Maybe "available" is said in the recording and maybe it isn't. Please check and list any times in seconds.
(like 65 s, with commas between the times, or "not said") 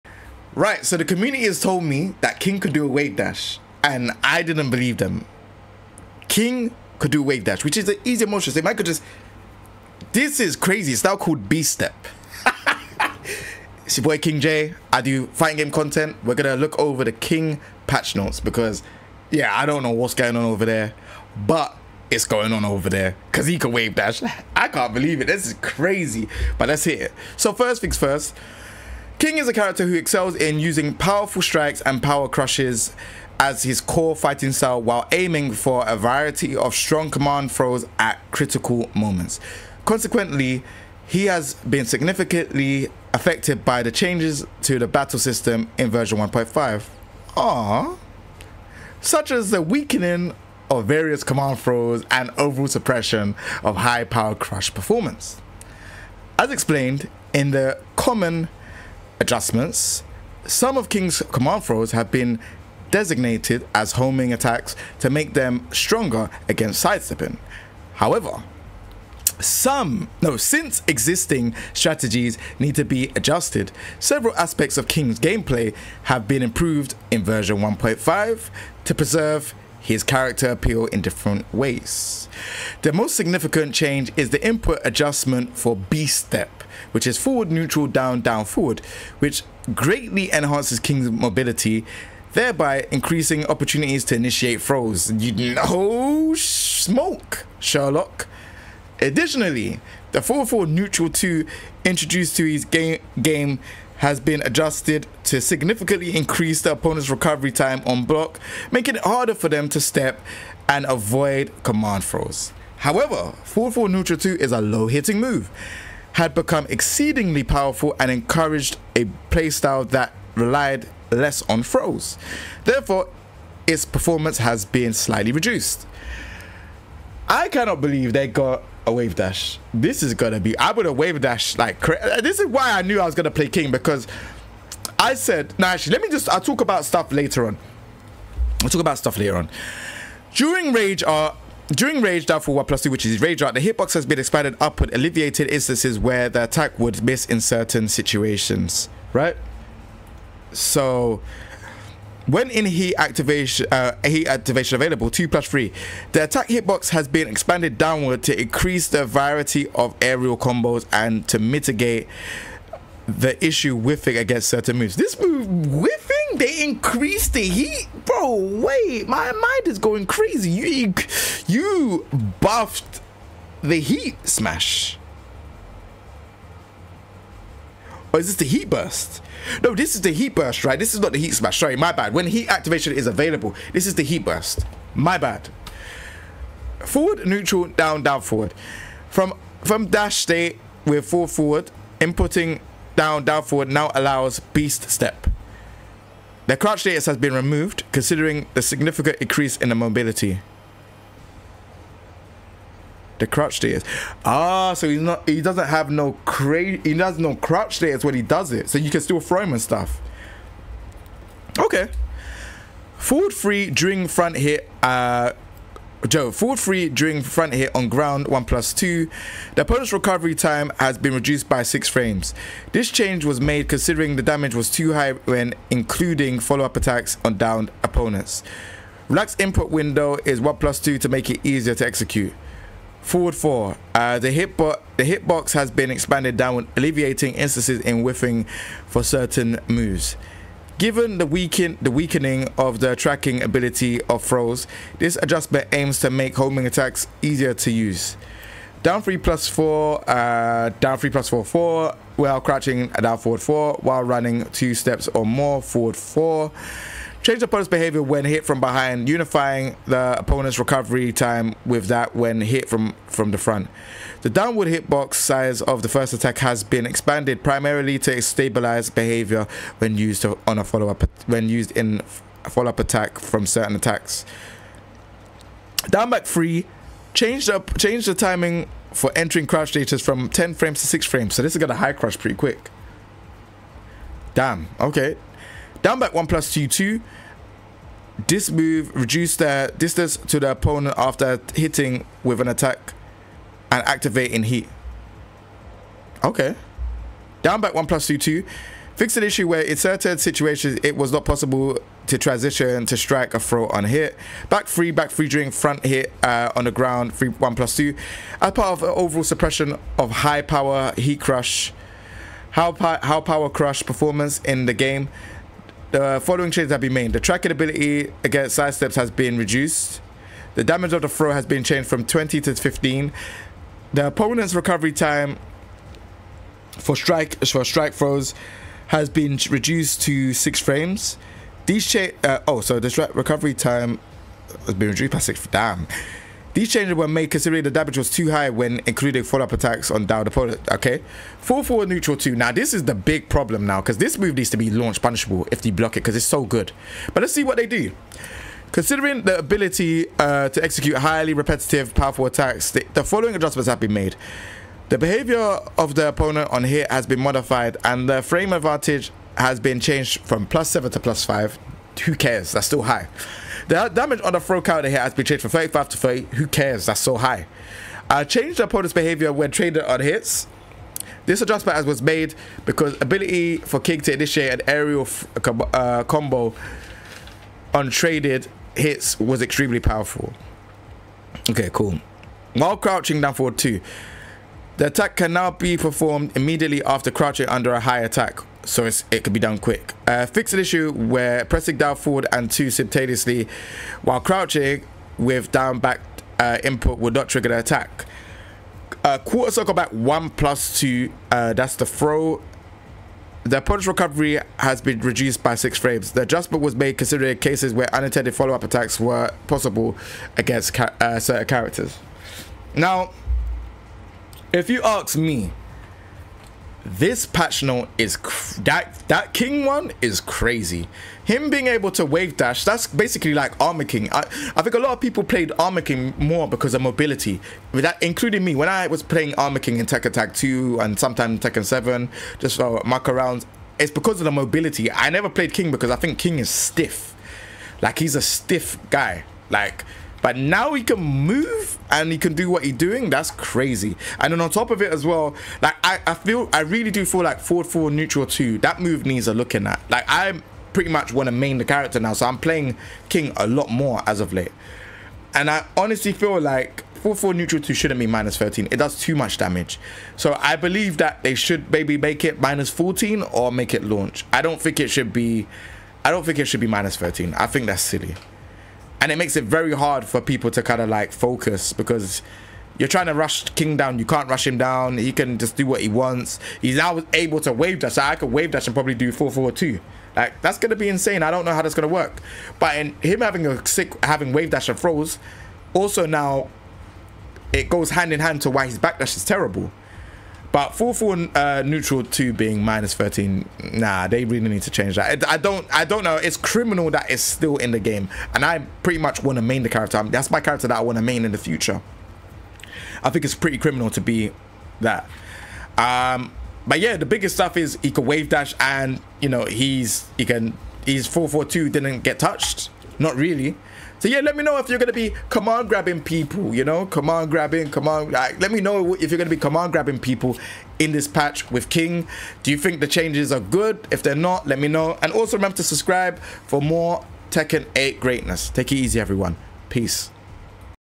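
154 s, 183 s.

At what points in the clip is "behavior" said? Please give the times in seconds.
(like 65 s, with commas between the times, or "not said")
257 s, 268 s, 354 s, 368 s.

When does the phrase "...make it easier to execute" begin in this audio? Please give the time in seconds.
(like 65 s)
231 s.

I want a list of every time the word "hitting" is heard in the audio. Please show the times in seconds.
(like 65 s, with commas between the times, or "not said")
114 s, 291 s.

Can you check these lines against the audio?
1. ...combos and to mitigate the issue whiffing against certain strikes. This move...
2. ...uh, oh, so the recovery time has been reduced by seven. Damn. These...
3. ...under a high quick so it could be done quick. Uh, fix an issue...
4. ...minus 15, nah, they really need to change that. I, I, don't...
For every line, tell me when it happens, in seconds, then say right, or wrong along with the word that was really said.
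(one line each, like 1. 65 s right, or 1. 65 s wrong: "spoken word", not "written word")
1. 160 s wrong: "moves", not "strikes"
2. 332 s wrong: "six", not "seven"
3. 387 s wrong: "attack", not "quick"
4. 492 s wrong: "13", not "15".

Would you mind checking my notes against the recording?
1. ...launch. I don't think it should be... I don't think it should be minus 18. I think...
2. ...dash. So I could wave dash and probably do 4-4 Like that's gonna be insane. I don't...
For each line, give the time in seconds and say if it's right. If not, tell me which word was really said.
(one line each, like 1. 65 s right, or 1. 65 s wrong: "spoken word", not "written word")
1. 463 s wrong: "13", not "18"
2. 477 s right.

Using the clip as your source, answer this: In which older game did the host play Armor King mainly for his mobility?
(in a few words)
Tekken Tag 2.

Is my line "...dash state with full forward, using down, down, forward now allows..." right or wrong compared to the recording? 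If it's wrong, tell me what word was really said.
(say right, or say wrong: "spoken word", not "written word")
wrong: "inputting", not "using".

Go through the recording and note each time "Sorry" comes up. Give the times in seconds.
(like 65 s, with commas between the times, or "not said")
181 s.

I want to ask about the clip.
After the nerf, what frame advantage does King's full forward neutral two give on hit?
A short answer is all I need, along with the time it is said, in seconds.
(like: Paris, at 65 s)
plus 5, at 360 s.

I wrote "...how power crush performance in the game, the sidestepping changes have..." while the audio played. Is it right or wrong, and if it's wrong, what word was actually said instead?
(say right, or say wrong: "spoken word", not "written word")
wrong: "following", not "sidestepping".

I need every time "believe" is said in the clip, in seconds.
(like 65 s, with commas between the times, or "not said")
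4 s, 24 s, 127 s, 460 s.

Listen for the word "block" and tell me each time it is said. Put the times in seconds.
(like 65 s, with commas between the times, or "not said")
108 s, 345 s.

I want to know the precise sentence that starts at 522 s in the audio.
Do you think the changes are good?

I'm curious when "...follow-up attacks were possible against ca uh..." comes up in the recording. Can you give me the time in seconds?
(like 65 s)
408 s.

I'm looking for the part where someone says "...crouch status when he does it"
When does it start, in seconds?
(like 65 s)
207 s.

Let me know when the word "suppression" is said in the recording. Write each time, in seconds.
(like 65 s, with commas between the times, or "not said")
52 s, 309 s.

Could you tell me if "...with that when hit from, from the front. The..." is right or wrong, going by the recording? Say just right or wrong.
right.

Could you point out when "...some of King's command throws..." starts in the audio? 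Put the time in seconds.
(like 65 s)
60 s.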